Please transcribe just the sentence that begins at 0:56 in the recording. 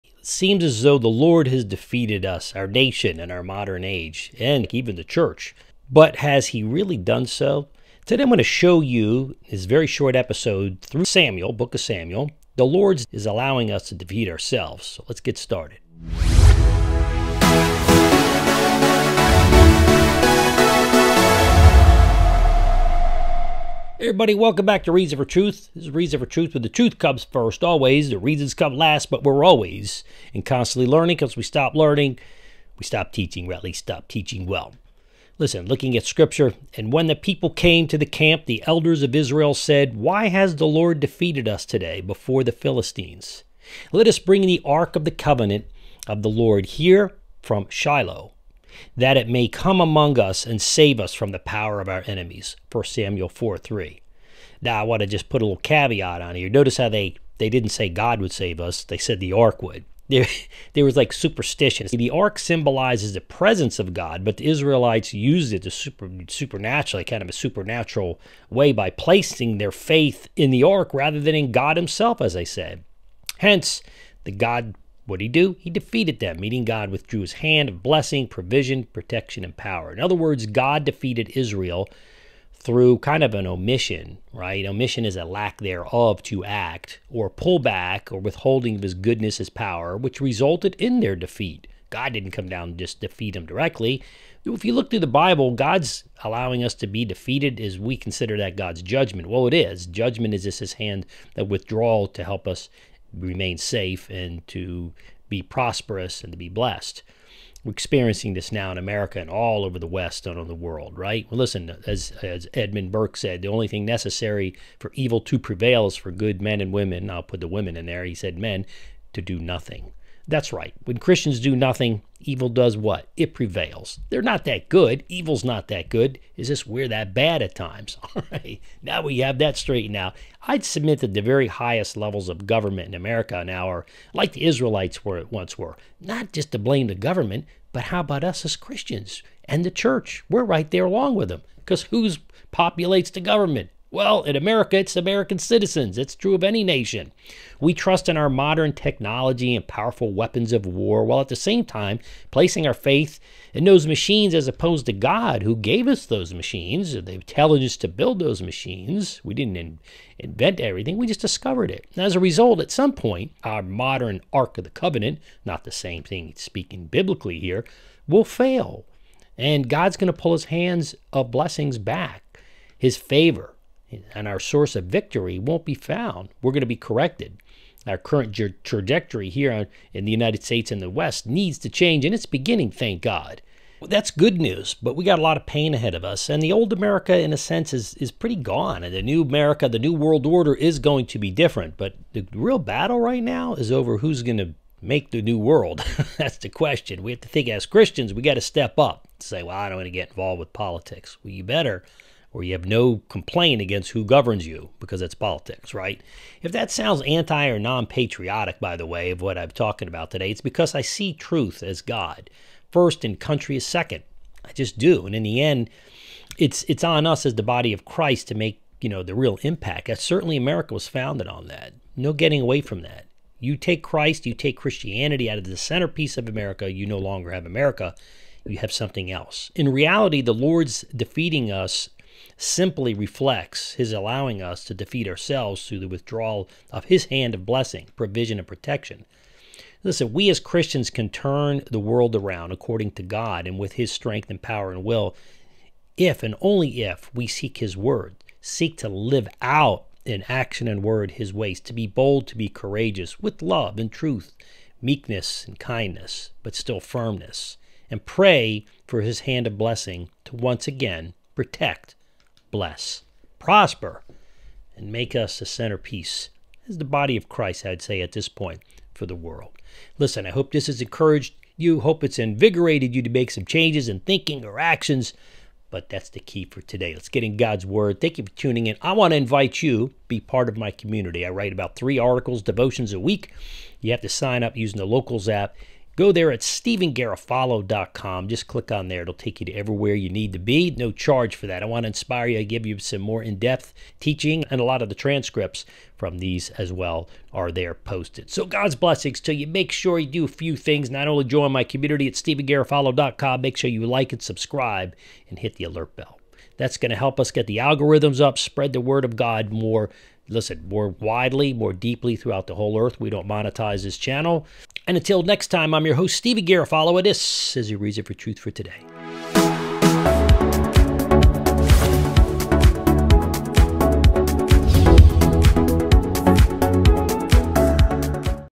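Notice how they they didn't say God would save us; they said the ark would.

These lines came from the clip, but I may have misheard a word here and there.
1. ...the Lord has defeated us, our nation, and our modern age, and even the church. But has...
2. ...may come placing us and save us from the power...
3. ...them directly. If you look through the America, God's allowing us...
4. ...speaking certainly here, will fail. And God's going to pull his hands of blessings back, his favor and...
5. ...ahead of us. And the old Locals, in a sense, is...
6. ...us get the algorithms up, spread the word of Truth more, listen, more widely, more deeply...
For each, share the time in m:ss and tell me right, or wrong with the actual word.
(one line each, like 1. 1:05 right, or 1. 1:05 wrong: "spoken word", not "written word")
1. 0:00 right
2. 0:49 wrong: "among", not "placing"
3. 1:33 wrong: "Bible", not "America"
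4. 2:46 wrong: "biblically", not "certainly"
5. 3:05 wrong: "America", not "Locals"
6. 5:07 wrong: "God", not "Truth".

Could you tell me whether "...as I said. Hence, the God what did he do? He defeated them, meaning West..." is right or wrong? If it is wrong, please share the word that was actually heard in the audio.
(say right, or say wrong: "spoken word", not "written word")
wrong: "God", not "West".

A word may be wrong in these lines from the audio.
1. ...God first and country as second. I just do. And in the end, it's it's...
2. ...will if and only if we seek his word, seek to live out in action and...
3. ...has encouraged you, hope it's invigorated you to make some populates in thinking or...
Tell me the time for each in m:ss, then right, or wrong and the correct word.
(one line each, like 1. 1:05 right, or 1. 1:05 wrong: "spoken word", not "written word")
1. 3:31 right
2. 4:04 right
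3. 4:30 wrong: "changes", not "populates".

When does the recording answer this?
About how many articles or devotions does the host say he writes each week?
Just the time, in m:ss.
4:41.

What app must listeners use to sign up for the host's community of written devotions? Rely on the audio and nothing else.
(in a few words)
Locals.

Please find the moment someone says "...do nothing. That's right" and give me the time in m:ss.
1:59.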